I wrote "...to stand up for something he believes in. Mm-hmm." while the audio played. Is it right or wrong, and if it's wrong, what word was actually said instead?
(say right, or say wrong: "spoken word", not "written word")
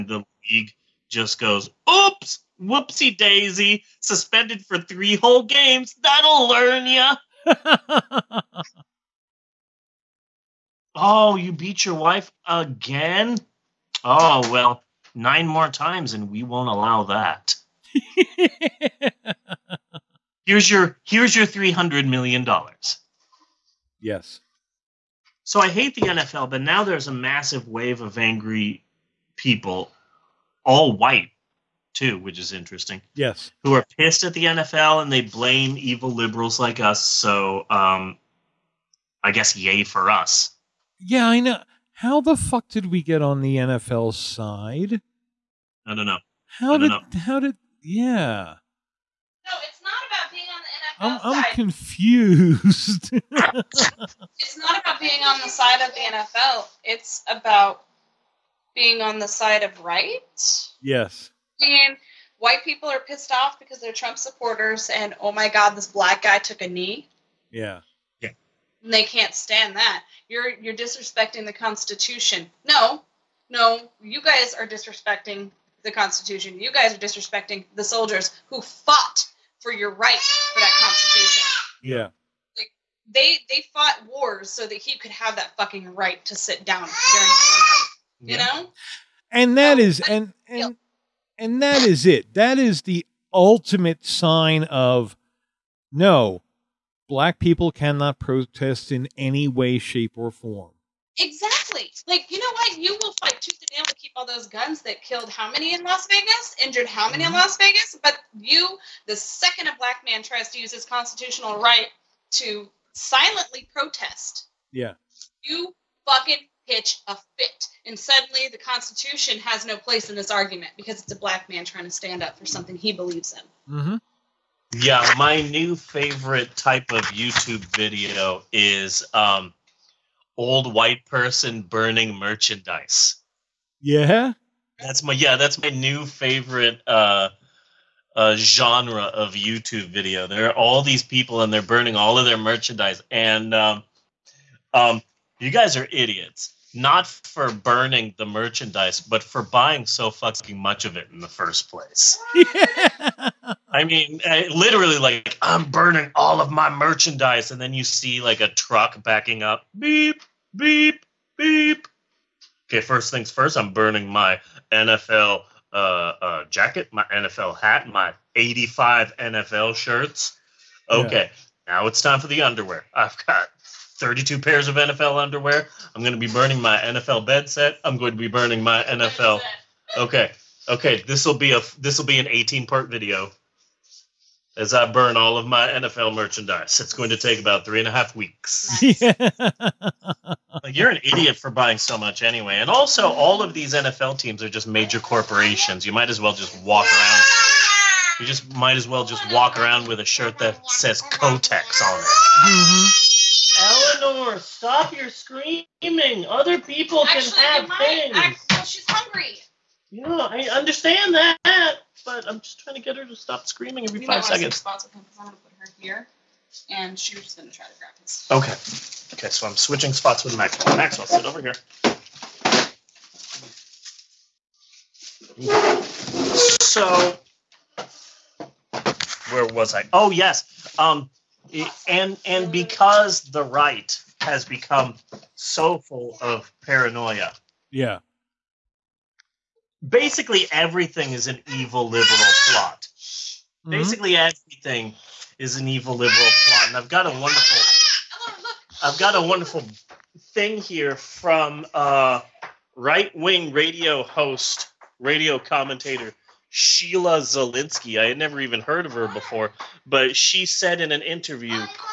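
right.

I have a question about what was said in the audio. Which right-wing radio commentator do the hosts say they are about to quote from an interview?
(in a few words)
Sheila Zilinsky.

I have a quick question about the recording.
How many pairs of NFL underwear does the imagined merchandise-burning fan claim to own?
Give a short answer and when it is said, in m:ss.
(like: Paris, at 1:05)
32, at 2:53.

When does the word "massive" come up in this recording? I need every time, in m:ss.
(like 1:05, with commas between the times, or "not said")
0:27.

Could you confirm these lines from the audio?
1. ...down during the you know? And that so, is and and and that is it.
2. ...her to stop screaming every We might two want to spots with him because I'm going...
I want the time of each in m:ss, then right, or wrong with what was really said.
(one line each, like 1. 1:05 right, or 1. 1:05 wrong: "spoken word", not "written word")
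1. 1:26 right
2. 3:32 wrong: "five", not "two".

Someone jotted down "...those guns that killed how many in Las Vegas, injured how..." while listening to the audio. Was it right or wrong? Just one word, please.
right.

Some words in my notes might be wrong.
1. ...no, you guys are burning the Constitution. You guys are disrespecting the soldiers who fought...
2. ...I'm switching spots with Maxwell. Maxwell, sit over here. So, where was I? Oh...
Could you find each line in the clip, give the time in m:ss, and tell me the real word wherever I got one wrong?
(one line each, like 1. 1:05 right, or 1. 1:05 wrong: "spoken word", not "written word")
1. 1:13 wrong: "disrespecting", not "burning"
2. 3:39 right.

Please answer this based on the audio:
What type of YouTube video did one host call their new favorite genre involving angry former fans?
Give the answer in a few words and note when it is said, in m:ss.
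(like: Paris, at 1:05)
old white person burning merchandise, at 2:10.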